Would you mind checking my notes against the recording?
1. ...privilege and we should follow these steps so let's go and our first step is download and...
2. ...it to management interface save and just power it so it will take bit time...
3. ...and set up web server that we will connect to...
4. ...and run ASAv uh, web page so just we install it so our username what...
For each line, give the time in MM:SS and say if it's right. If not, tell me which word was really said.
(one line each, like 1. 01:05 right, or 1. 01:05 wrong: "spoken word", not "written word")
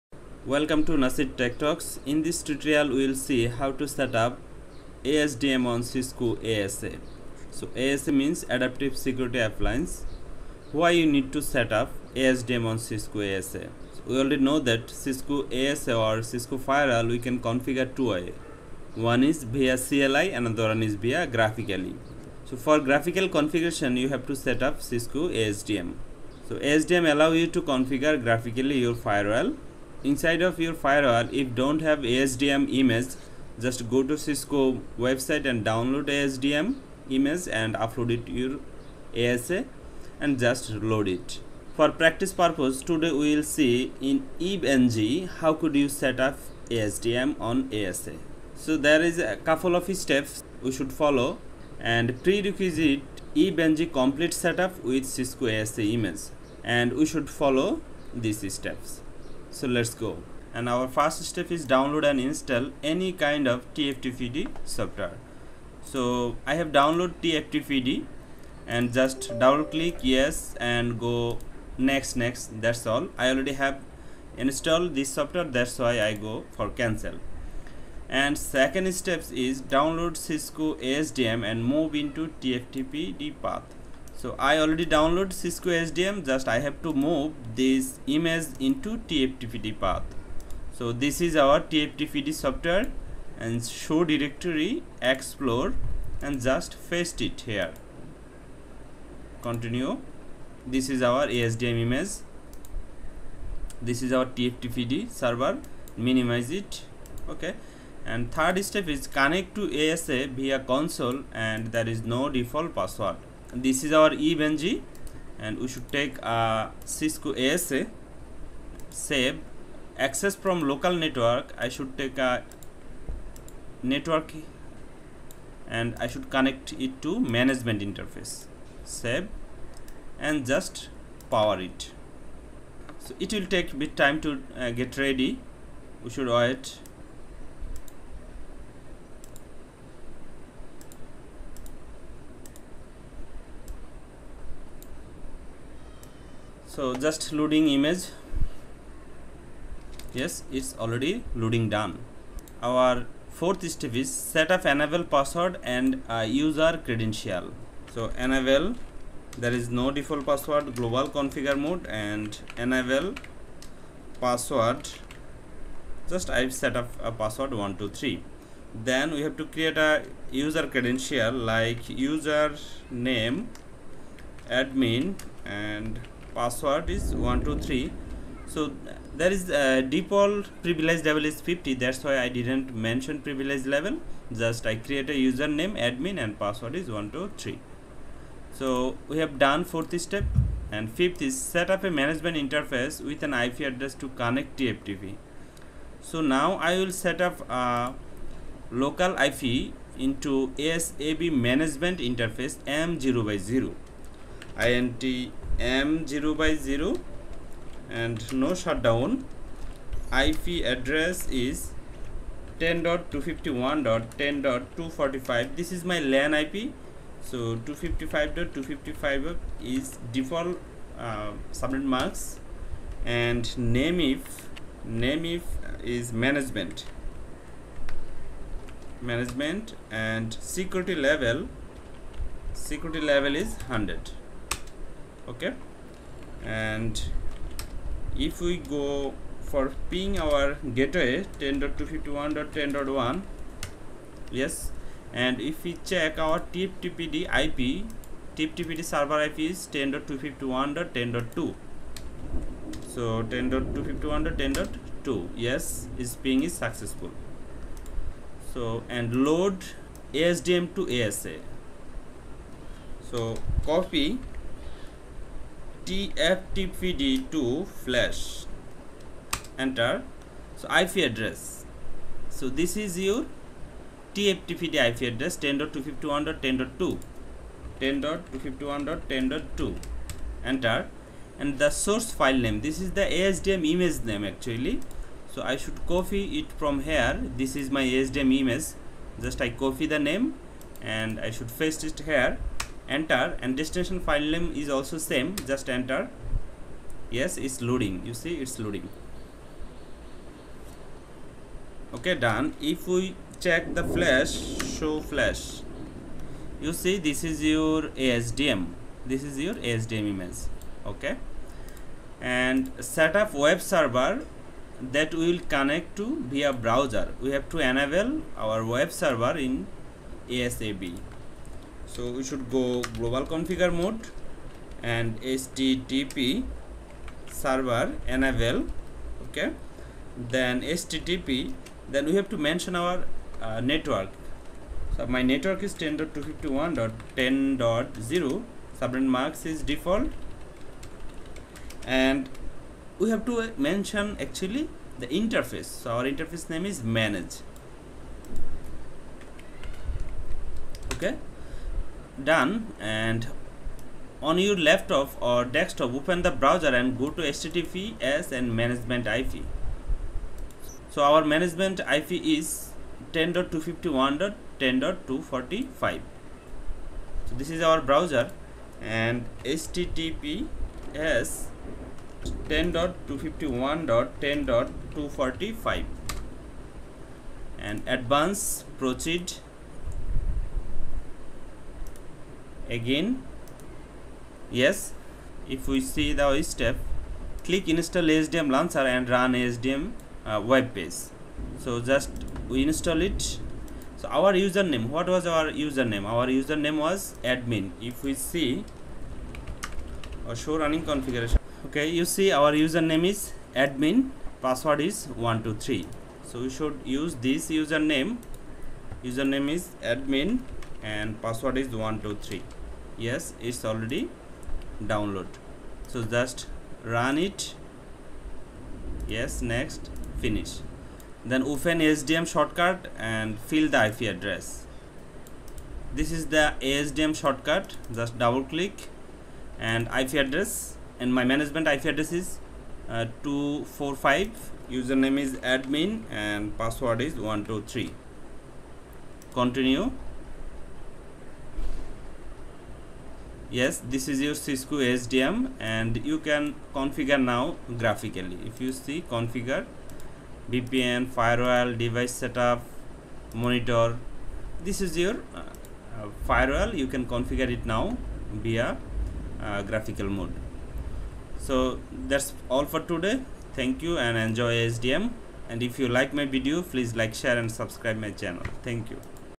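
1. 00:55 wrong: "image", not "privilege"
2. 02:06 right
3. 05:12 right
4. 06:28 wrong: "SDM", not "ASAv".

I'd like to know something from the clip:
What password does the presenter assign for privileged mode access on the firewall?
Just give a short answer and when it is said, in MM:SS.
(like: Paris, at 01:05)
123, at 02:42.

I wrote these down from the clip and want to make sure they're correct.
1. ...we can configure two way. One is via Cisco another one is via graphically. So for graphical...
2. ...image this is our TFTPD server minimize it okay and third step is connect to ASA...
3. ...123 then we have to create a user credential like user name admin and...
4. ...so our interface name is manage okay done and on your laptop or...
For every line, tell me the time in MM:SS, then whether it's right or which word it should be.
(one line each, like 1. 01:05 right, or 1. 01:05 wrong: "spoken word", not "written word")
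1. 00:17 wrong: "CLI", not "Cisco"
2. 01:41 right
3. 02:47 right
4. 05:45 right.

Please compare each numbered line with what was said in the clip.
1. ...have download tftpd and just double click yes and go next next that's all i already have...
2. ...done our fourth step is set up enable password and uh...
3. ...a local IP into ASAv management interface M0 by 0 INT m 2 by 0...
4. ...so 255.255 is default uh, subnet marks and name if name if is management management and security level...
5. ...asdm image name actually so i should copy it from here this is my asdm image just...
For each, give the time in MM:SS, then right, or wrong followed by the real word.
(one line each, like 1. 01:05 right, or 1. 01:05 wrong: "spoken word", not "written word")
1. 01:06 right
2. 02:31 right
3. 03:17 wrong: "0", not "2"
4. 03:37 right
5. 04:43 right.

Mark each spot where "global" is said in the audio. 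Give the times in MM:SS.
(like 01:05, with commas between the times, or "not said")
02:40, 05:22.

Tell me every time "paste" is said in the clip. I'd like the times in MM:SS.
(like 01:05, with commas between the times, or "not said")
01:36, 04:51.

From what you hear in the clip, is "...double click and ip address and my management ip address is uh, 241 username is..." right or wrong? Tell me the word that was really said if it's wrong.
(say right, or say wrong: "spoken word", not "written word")
wrong: "245", not "241".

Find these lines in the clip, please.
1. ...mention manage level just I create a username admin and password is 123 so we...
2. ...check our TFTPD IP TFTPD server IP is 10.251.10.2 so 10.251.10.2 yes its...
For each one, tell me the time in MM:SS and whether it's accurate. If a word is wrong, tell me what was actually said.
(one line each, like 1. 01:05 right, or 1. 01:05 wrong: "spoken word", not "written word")
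1. 03:02 wrong: "privilege", not "manage"
2. 04:05 right.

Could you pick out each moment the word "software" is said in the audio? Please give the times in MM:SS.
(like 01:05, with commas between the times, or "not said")
01:04, 01:15, 01:32.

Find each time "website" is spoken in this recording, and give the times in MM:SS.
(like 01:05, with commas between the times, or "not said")
00:35.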